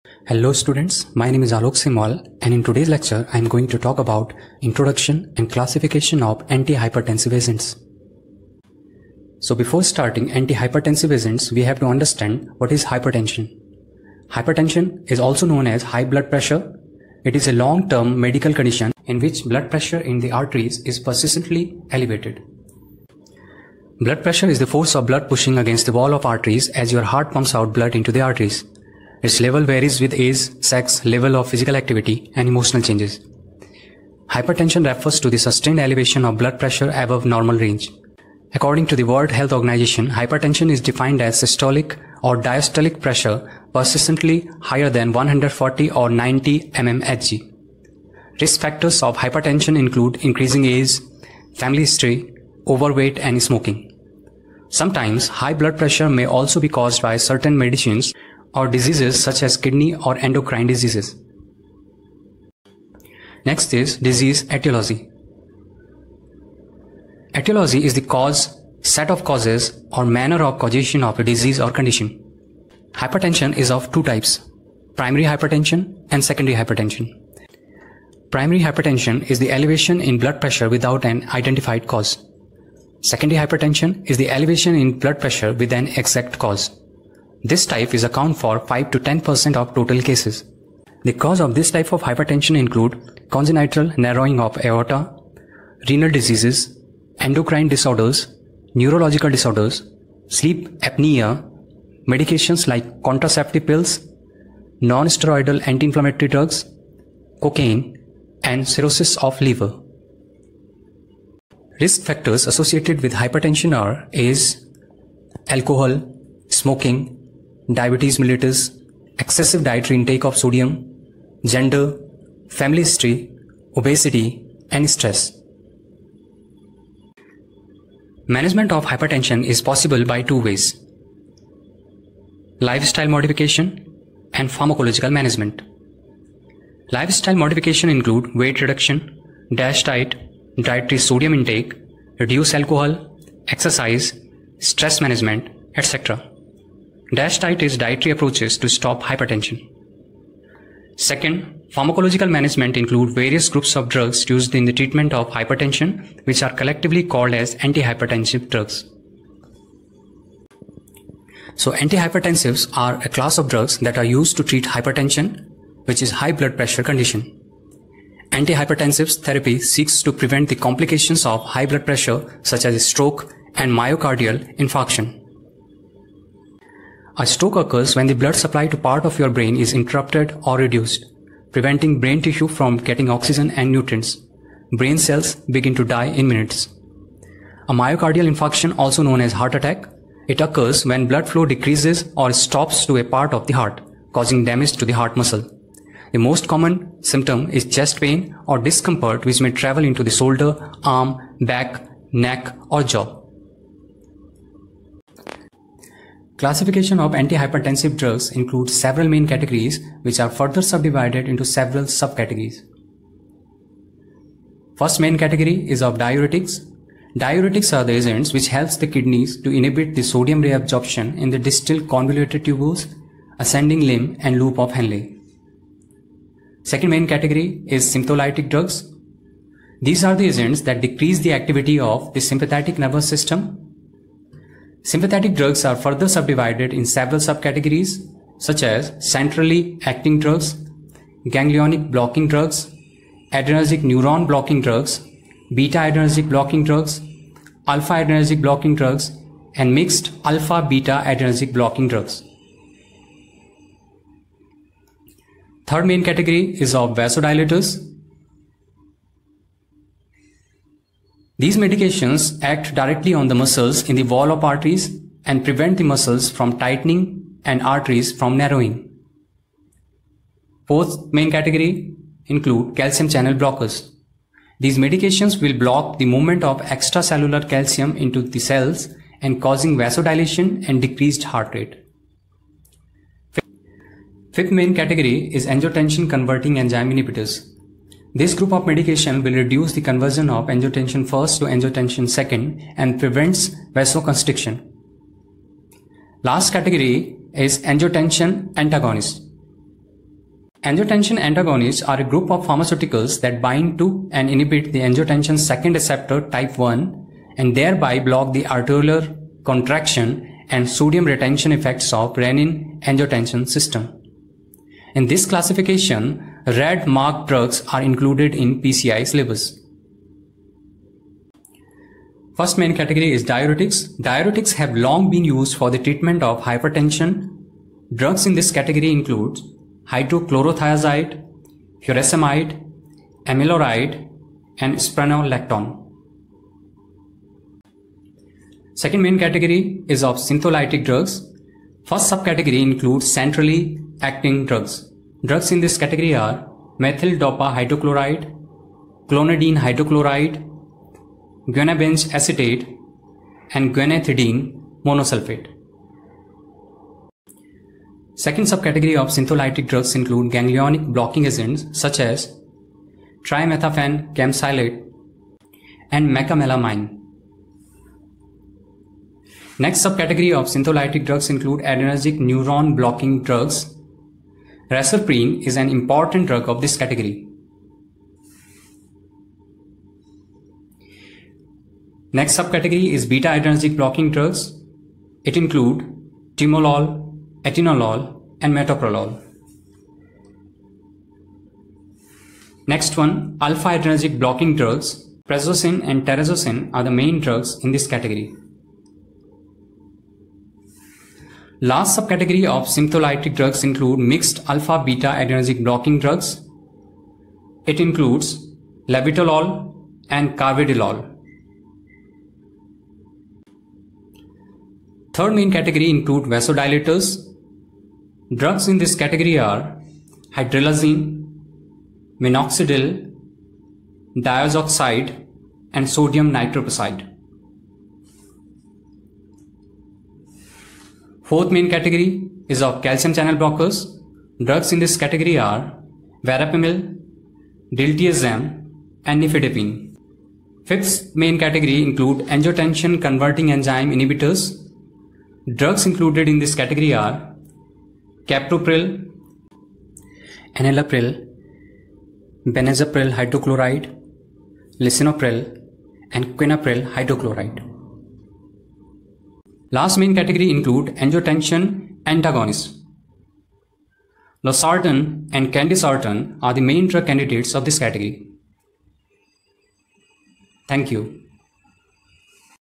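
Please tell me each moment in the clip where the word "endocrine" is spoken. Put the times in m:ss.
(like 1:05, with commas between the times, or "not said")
1:00, 1:37.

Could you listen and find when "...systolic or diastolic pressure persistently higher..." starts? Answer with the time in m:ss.
0:41.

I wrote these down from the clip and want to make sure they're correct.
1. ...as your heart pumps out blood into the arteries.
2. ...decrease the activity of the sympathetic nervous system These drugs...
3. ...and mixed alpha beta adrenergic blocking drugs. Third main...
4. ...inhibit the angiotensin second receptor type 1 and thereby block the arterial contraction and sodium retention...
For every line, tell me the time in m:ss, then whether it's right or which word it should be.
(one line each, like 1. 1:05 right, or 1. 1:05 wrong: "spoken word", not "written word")
1. 0:26 right
2. 3:50 wrong: "Sympathetic", not "These"
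3. 4:09 right
4. 5:04 right.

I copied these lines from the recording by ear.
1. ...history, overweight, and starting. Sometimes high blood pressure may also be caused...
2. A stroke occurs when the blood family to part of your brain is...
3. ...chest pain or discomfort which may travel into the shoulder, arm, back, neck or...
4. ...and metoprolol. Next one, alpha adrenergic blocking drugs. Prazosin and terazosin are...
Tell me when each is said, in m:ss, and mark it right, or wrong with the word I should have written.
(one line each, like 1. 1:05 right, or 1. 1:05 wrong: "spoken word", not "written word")
1. 0:51 wrong: "smoking", not "starting"
2. 2:57 wrong: "supply", not "family"
3. 3:17 right
4. 6:28 right.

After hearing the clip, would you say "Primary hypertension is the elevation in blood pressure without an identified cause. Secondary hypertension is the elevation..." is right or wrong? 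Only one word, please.
right.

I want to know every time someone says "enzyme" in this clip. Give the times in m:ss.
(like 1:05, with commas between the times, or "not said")
4:46, 7:23.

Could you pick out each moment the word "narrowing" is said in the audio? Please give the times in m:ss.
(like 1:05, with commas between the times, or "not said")
1:33, 4:28.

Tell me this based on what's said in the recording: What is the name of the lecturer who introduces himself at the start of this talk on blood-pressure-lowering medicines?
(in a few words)
Alok.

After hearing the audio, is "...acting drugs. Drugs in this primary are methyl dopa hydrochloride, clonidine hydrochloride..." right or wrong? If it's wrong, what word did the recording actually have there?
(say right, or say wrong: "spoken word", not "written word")
wrong: "category", not "primary".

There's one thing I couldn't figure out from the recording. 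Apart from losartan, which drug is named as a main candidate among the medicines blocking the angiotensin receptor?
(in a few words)
candesartan.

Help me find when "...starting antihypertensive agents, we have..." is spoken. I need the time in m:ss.
0:09.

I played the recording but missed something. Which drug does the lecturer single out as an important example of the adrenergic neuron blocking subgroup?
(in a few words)
Reserpine.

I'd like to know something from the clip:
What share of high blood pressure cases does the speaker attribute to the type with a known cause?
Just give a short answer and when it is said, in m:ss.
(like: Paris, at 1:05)
5 to 10%, at 1:28.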